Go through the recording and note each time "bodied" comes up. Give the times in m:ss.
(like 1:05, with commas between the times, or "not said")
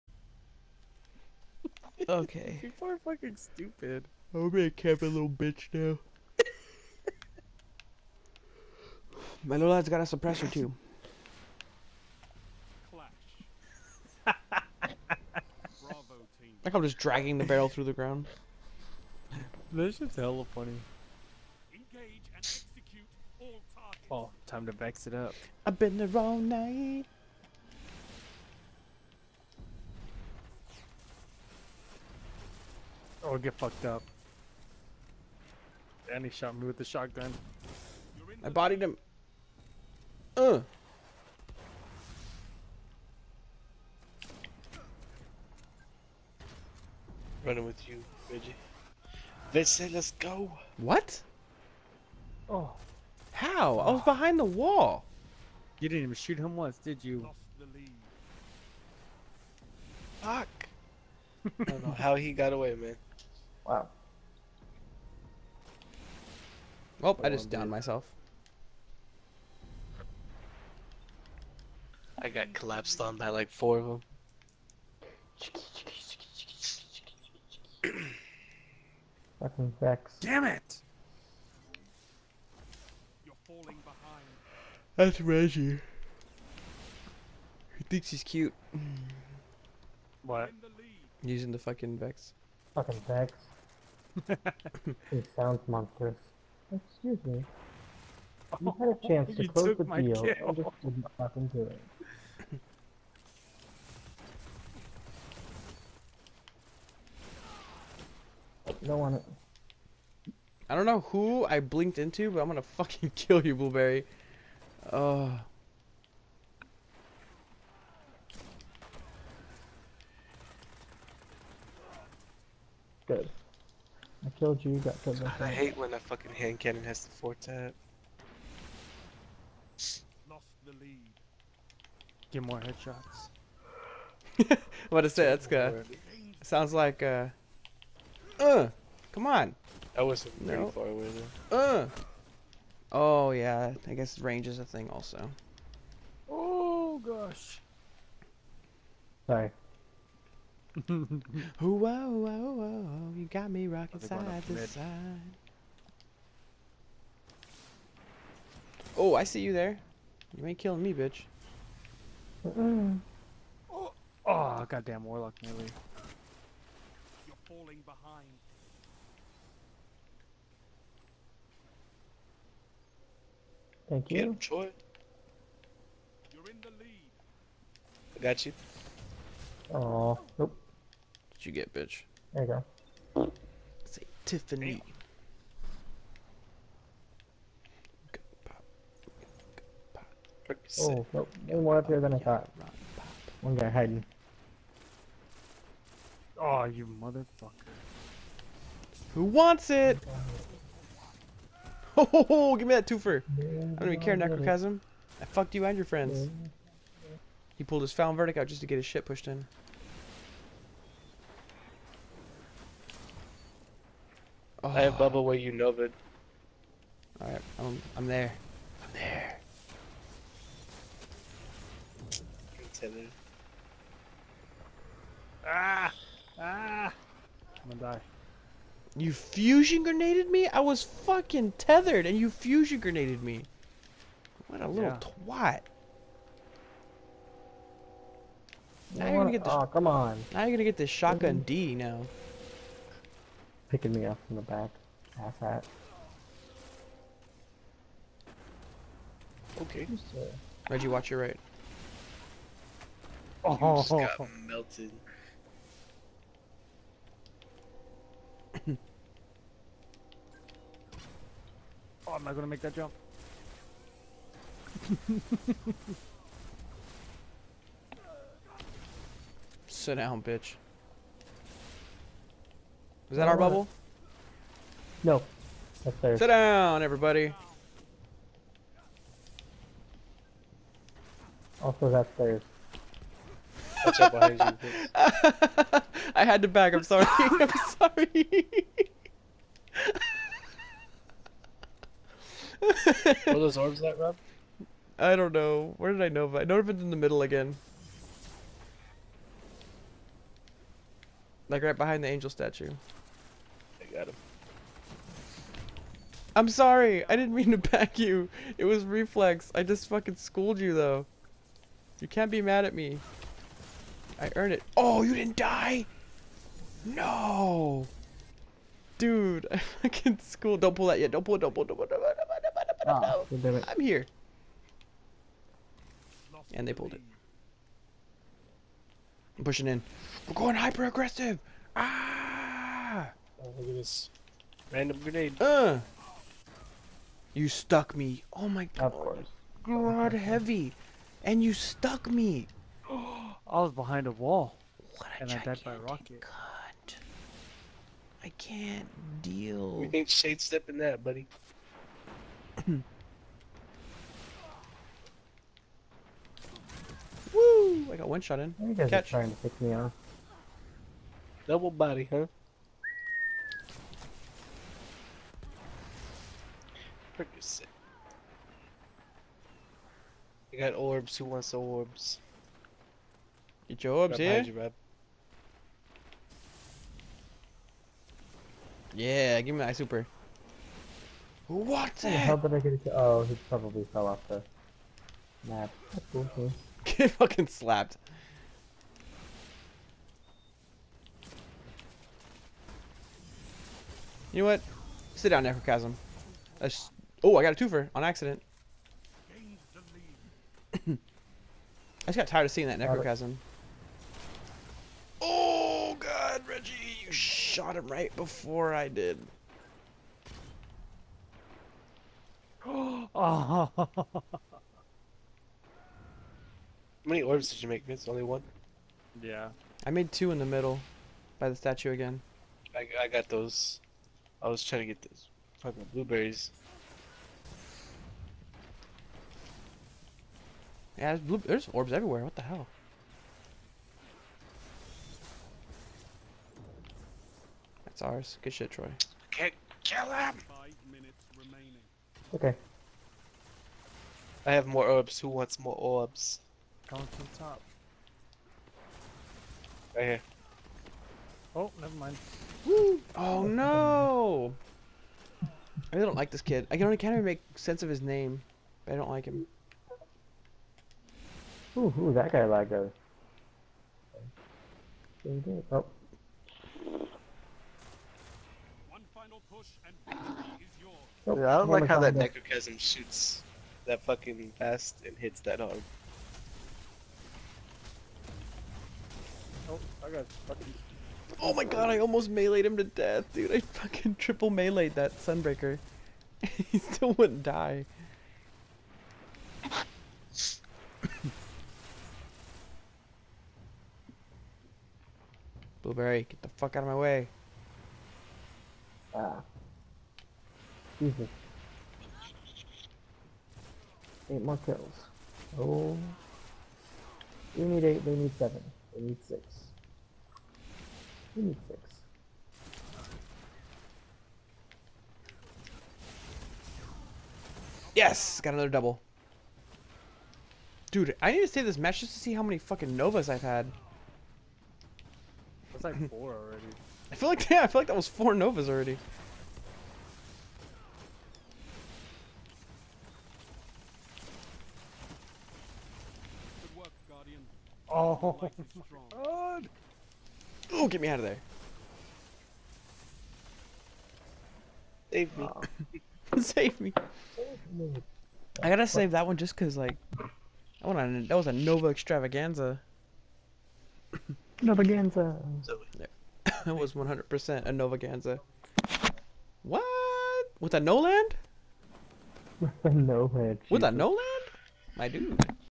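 0:38.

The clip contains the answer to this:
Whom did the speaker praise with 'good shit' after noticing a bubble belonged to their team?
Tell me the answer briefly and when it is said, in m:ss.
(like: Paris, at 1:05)
Troy, at 7:18.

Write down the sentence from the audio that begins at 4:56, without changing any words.
I know if it's in the middle again.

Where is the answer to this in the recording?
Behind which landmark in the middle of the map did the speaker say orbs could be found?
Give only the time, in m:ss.
5:02.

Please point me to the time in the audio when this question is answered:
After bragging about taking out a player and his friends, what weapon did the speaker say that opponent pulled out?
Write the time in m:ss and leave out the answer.
3:27.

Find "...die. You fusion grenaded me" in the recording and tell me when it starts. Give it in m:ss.
3:47.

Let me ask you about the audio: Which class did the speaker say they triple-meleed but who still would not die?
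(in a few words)
Sunbreaker.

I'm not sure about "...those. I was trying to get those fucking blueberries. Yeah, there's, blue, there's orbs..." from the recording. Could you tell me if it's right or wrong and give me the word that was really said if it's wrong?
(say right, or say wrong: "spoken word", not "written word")
right.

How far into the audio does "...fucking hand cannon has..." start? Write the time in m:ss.
2:05.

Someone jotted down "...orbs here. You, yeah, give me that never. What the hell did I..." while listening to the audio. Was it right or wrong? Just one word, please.
wrong.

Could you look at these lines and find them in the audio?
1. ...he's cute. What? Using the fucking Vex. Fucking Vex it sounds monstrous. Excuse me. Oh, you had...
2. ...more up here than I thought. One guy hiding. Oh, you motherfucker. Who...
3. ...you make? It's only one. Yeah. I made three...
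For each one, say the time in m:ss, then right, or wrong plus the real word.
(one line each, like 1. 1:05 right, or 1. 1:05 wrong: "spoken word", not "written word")
1. 1:28 right
2. 3:11 right
3. 6:57 wrong: "two", not "three".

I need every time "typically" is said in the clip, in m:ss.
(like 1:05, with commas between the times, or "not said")
not said.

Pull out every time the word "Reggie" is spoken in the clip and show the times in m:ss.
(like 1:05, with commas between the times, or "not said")
0:48, 1:25, 4:10, 6:46.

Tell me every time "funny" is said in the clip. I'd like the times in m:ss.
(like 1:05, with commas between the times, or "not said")
0:20.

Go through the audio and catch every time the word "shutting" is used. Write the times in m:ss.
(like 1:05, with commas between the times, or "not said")
not said.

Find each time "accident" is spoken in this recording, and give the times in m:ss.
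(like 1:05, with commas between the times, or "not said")
6:38.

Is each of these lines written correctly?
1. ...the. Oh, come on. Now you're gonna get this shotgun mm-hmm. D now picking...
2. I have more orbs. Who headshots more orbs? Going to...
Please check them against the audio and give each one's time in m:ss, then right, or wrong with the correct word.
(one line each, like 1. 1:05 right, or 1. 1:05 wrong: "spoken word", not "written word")
1. 3:59 right
2. 7:24 wrong: "wants", not "headshots".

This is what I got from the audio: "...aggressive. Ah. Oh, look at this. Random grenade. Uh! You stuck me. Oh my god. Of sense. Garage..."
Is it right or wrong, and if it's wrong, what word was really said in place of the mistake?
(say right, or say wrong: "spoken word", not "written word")
wrong: "course", not "sense".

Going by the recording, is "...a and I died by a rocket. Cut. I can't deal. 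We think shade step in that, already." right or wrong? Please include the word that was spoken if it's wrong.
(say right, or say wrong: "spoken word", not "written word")
wrong: "buddy", not "already".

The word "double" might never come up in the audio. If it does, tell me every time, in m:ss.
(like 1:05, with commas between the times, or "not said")
6:01, 8:38.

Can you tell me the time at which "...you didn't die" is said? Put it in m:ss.
5:15.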